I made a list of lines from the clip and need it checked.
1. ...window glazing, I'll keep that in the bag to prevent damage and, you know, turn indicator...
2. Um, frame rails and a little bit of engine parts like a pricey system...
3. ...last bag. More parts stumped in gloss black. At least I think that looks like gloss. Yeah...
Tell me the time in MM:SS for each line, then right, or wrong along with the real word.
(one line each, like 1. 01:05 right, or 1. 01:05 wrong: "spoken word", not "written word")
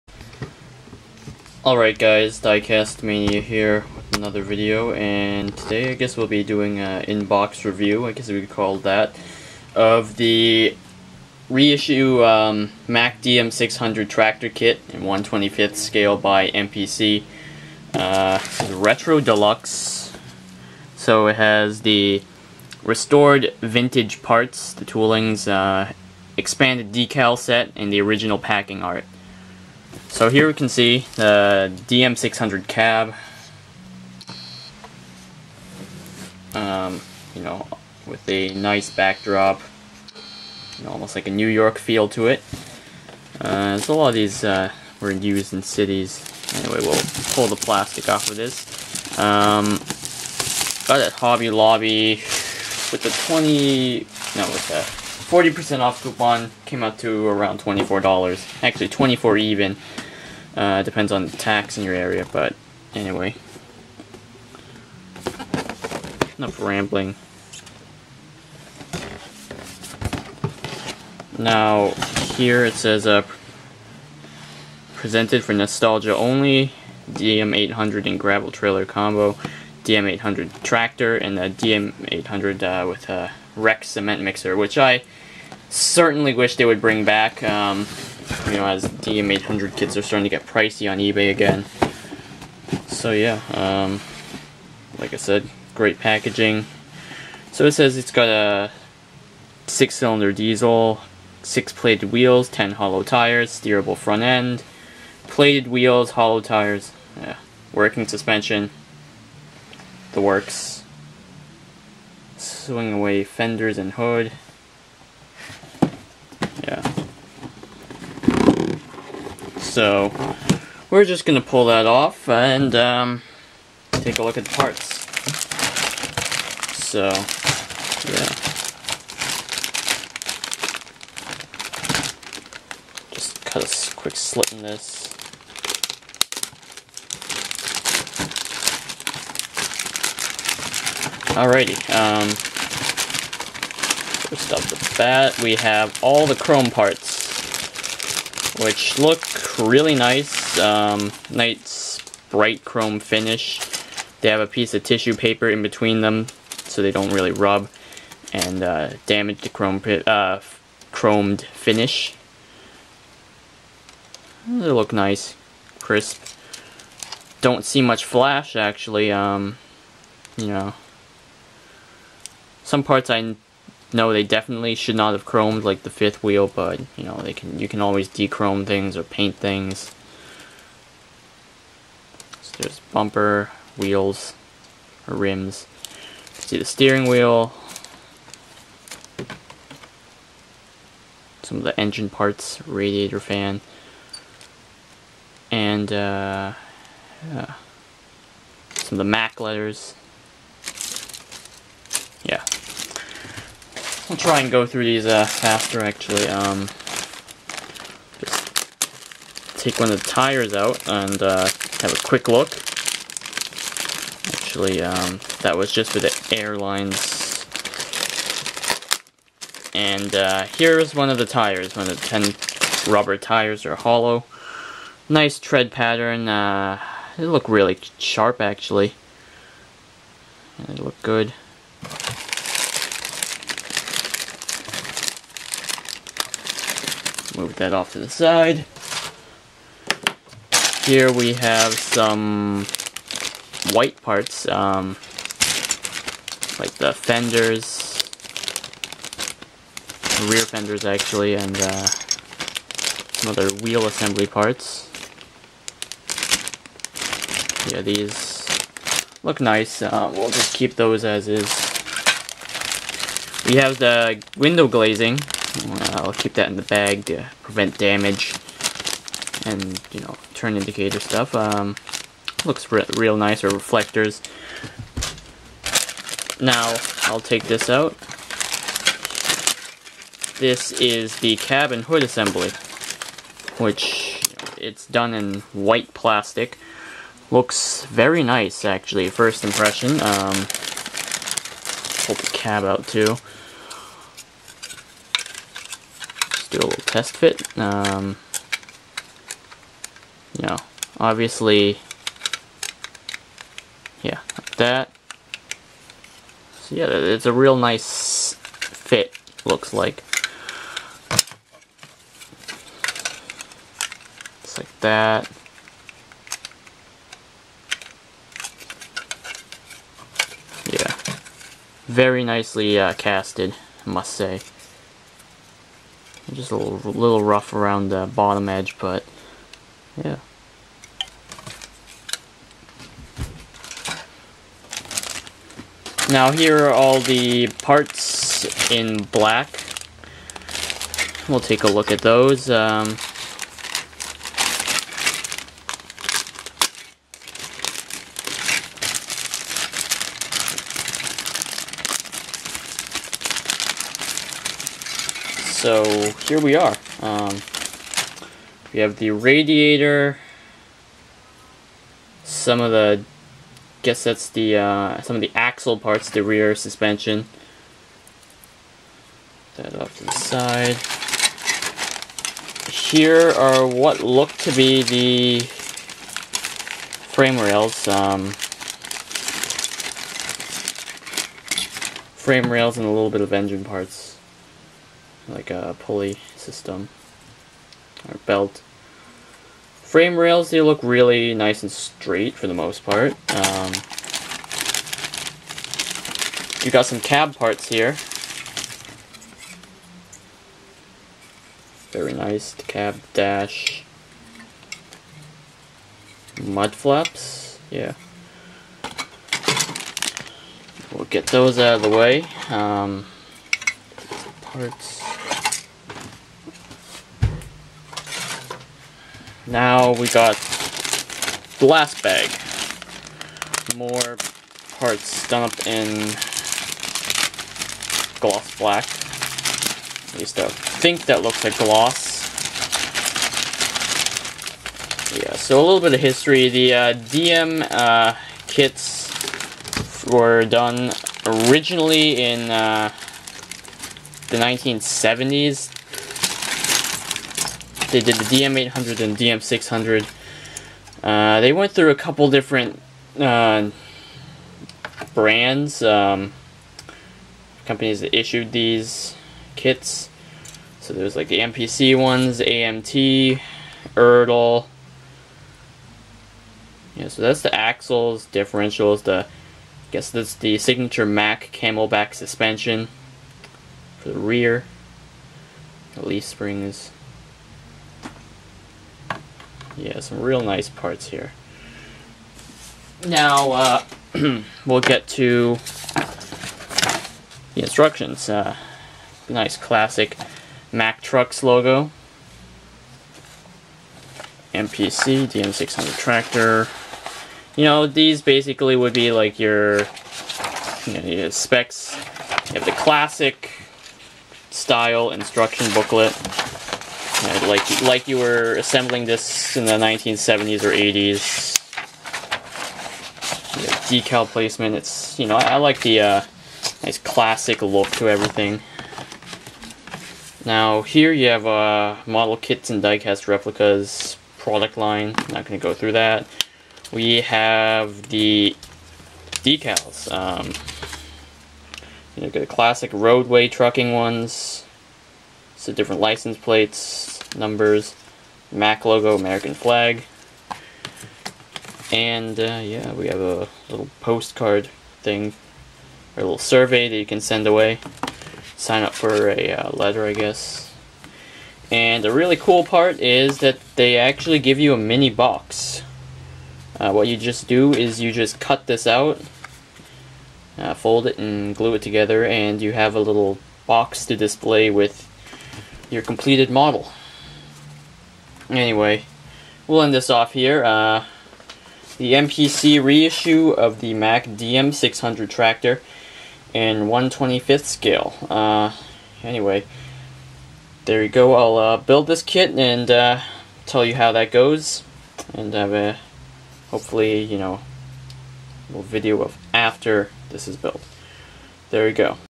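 1. 04:24 right
2. 06:17 wrong: "pulley", not "pricey"
3. 07:01 right.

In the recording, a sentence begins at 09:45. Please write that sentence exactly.
And have a, hopefully, you know, little video of after this is built.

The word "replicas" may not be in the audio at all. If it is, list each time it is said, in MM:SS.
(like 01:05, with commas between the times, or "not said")
08:43.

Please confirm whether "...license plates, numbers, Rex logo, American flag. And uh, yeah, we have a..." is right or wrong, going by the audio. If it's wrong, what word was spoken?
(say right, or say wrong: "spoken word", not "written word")
wrong: "Mack", not "Rex".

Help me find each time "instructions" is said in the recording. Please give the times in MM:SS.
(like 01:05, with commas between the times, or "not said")
08:07, 08:25.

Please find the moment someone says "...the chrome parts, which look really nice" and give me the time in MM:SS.
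02:26.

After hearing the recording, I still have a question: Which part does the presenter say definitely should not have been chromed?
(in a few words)
Fifth wheel.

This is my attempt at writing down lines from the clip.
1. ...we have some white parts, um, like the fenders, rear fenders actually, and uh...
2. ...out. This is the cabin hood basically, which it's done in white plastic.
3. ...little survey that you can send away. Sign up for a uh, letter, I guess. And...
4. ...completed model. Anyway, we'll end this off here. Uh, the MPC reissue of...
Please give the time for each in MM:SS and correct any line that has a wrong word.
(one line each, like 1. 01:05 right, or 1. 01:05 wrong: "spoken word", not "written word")
1. 04:01 right
2. 04:37 wrong: "assembly", not "basically"
3. 09:06 right
4. 09:26 right.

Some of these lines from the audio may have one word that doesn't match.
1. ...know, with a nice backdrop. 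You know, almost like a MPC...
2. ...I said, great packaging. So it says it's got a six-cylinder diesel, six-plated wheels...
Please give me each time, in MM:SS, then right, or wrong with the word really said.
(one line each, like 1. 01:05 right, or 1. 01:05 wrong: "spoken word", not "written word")
1. 00:37 wrong: "New", not "MPC"
2. 01:35 right.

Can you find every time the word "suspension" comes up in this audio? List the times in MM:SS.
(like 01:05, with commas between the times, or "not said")
01:48, 06:06, 07:52.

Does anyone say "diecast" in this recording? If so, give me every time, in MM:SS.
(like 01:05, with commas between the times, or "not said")
00:02, 08:42.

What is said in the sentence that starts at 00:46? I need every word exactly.
Anyway, we'll pull the plastic off of this.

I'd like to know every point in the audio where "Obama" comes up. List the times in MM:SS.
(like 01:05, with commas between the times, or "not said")
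not said.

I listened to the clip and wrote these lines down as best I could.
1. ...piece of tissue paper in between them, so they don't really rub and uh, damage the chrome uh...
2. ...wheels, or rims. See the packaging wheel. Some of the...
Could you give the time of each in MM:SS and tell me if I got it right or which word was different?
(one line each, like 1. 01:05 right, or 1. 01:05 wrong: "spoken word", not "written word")
1. 02:34 right
2. 03:03 wrong: "steering", not "packaging".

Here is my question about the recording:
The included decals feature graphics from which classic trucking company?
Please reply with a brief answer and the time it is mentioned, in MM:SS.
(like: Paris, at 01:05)
Roadway, at 08:52.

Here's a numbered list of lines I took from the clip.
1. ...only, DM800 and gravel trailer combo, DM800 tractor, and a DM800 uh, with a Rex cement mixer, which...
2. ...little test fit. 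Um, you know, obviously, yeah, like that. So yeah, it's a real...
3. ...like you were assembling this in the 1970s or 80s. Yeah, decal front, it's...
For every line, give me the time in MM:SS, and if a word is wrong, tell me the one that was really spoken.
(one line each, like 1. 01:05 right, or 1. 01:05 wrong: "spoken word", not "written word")
1. 01:16 right
2. 04:56 right
3. 08:27 wrong: "placement", not "front".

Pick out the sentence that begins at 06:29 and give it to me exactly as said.
Frame rails, they look really nice and straight for the most part.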